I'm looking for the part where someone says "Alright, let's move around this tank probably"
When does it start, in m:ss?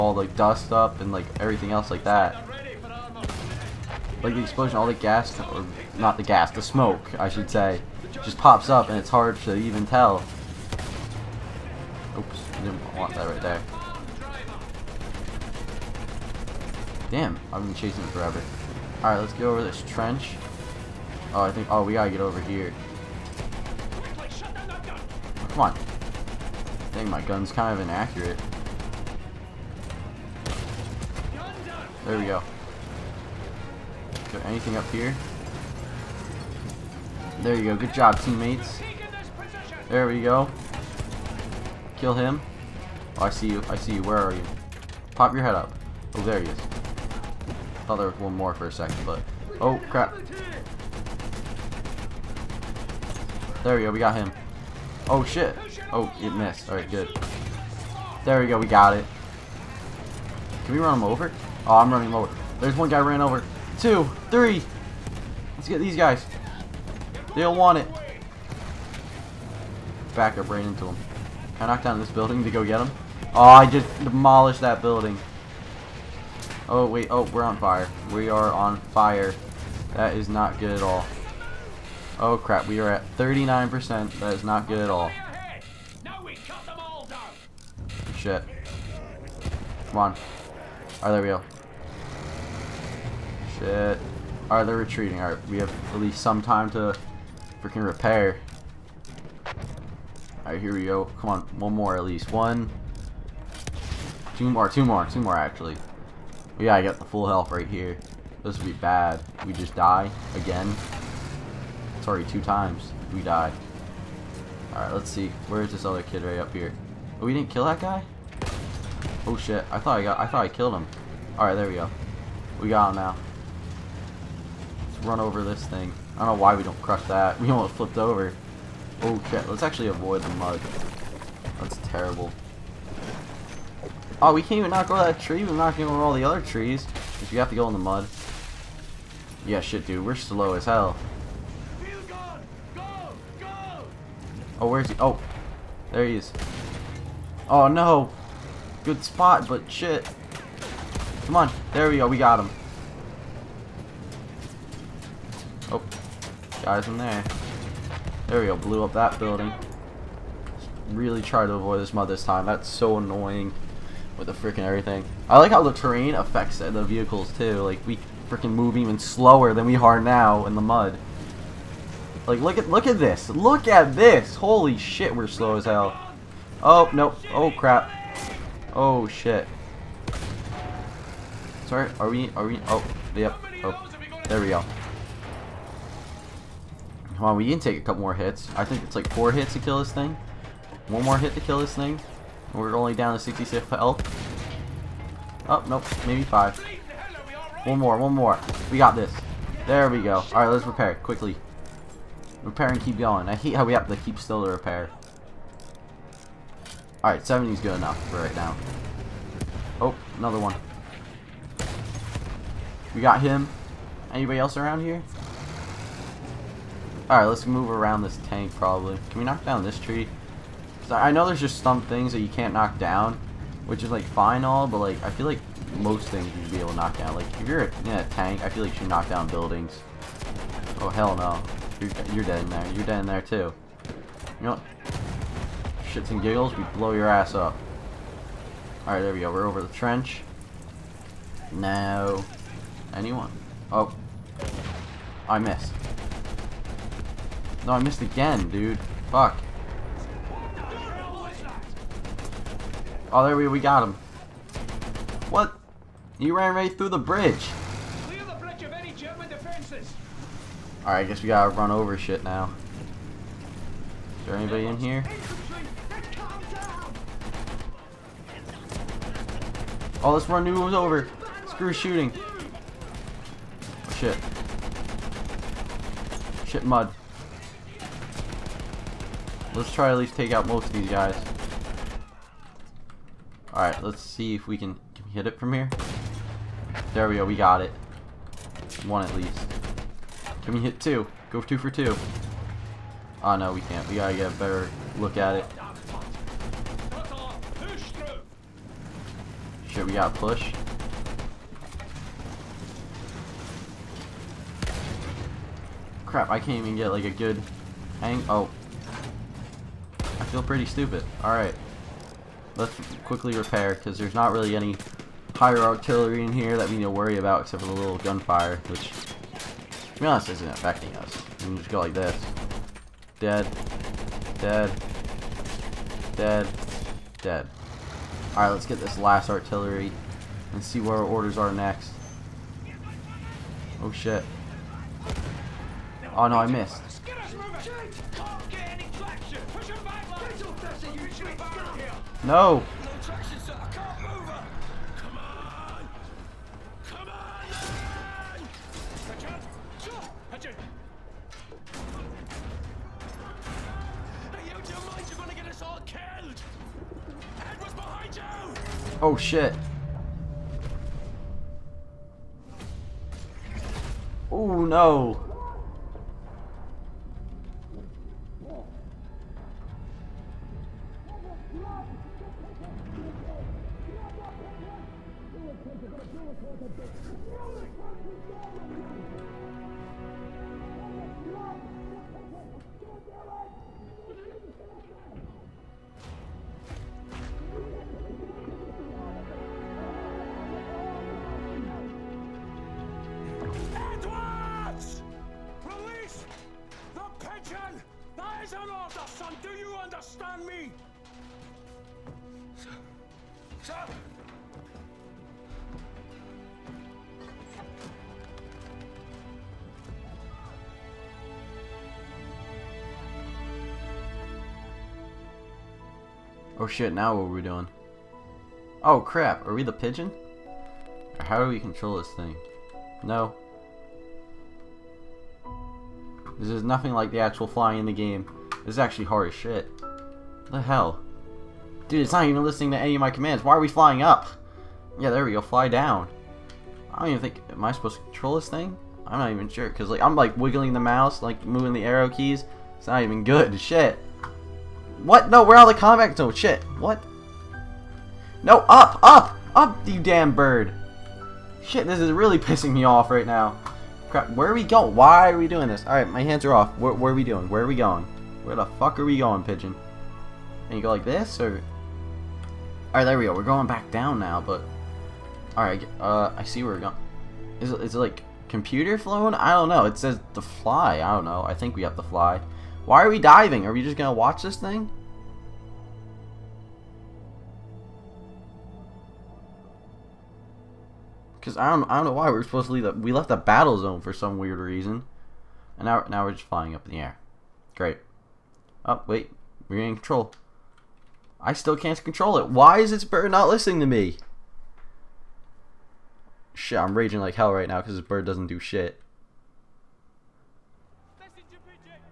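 3:37.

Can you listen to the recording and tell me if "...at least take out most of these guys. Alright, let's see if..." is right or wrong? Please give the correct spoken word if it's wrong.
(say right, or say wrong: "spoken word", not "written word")
right.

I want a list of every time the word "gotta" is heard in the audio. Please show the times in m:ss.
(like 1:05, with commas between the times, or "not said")
0:21, 4:21, 4:53, 4:59.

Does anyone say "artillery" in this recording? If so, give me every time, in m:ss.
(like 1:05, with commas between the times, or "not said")
5:15, 5:29.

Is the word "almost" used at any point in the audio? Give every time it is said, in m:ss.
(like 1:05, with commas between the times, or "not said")
2:07.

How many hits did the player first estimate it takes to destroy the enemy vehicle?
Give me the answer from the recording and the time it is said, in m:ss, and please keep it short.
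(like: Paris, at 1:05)
4, at 3:09.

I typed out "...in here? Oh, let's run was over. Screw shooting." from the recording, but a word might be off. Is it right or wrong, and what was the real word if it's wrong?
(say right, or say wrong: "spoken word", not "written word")
right.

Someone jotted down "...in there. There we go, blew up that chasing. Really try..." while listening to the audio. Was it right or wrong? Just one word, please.
wrong.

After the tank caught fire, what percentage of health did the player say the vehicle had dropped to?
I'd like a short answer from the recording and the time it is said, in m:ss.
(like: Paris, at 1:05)
39%, at 1:23.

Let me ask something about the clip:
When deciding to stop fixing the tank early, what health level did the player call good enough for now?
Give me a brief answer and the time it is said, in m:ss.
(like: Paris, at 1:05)
70, at 3:27.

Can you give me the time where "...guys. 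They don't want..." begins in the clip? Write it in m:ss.
1:05.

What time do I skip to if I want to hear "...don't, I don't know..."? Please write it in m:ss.
8:01.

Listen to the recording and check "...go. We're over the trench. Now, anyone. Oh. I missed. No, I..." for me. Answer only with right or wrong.
right.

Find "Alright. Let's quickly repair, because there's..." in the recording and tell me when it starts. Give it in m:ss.
5:11.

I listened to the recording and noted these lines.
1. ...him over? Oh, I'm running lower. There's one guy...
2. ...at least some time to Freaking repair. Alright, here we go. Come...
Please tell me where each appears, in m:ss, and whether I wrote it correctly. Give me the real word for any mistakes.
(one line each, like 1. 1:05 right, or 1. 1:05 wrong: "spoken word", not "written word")
1. 1:00 right
2. 1:35 right.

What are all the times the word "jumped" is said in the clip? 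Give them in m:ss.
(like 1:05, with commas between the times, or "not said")
not said.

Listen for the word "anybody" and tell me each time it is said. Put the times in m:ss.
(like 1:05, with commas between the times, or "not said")
3:34, 4:24.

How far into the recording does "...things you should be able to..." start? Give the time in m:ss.
3:46.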